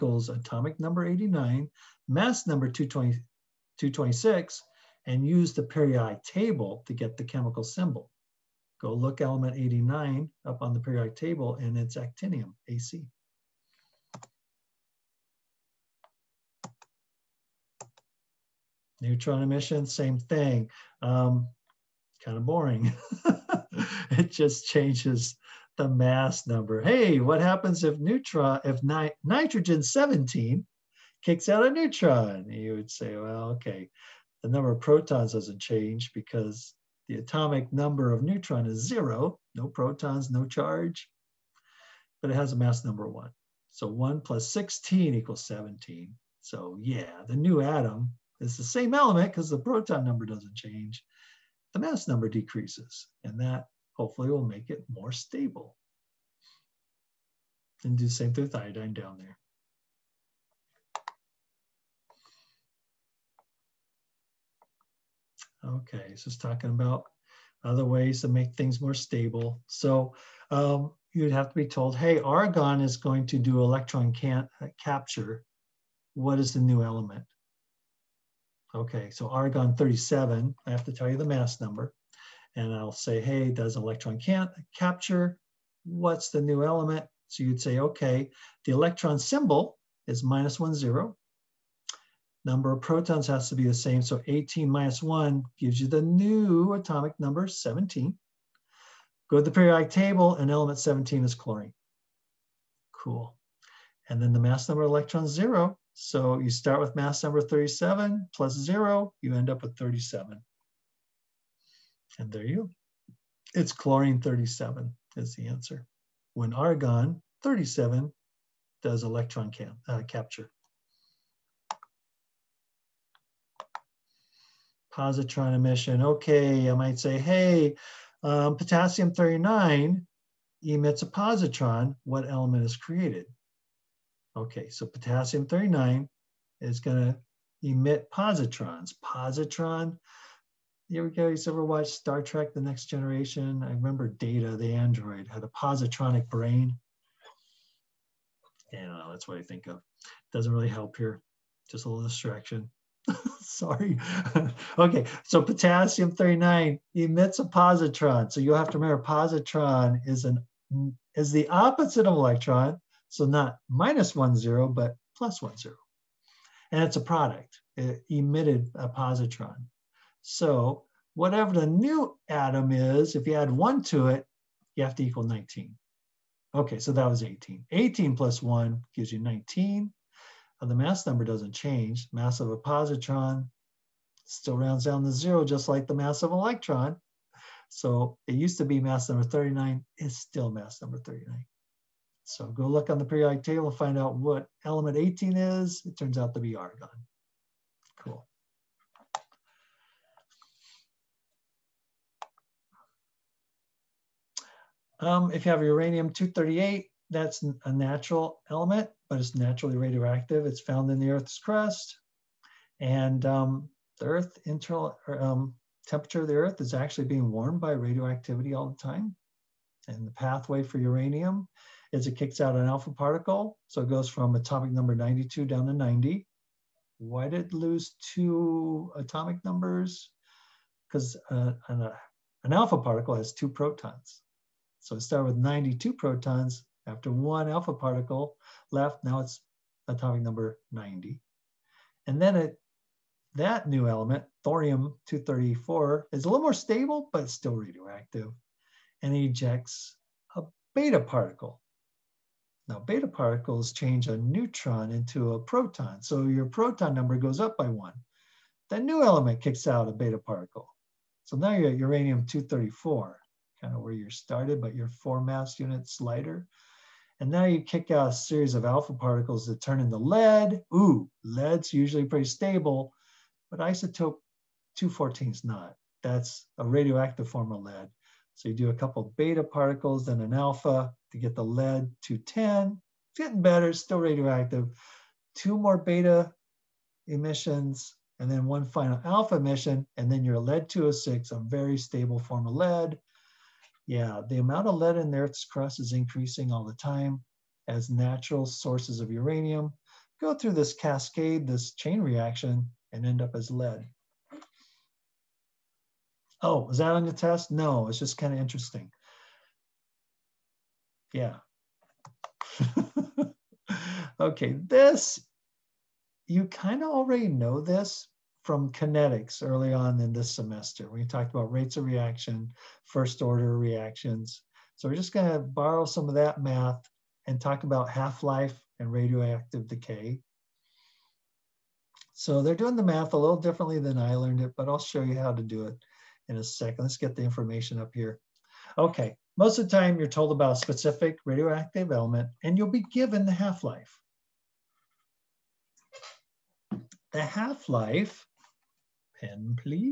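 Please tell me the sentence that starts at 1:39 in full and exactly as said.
Go to the periodic table and element 17 is chlorine.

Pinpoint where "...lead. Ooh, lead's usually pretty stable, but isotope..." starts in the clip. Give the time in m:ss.
4:29.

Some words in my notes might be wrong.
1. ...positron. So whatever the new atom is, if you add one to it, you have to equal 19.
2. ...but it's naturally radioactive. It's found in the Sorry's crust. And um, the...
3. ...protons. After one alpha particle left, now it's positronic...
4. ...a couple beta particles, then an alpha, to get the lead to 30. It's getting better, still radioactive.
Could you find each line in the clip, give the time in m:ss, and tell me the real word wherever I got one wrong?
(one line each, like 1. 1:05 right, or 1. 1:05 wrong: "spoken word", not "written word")
1. 2:48 right
2. 3:29 wrong: "Earth", not "Sorry"
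3. 3:55 wrong: "atomic", not "positronic"
4. 4:38 wrong: "10", not "30".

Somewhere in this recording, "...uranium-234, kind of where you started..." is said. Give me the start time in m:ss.
4:21.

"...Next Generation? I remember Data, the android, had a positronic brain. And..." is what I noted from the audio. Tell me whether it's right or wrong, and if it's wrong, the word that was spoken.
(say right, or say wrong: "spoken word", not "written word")
right.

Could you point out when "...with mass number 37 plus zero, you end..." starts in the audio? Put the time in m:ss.
1:46.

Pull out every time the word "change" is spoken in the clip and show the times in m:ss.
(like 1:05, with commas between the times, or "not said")
0:24, 0:35, 0:50, 3:01, 4:13.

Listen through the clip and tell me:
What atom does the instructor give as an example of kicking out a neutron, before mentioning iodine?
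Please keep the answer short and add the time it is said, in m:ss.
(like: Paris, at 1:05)
nitrogen 17, at 0:29.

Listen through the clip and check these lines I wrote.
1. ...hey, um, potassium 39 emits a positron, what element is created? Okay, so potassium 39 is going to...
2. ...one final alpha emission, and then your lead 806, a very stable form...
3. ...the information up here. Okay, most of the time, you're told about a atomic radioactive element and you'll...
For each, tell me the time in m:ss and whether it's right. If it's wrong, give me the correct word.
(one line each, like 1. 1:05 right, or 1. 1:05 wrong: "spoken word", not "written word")
1. 2:07 right
2. 4:48 wrong: "206", not "806"
3. 5:37 wrong: "specific", not "atomic".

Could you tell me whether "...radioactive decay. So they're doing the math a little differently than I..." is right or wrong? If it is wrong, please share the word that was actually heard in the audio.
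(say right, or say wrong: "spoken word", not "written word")
right.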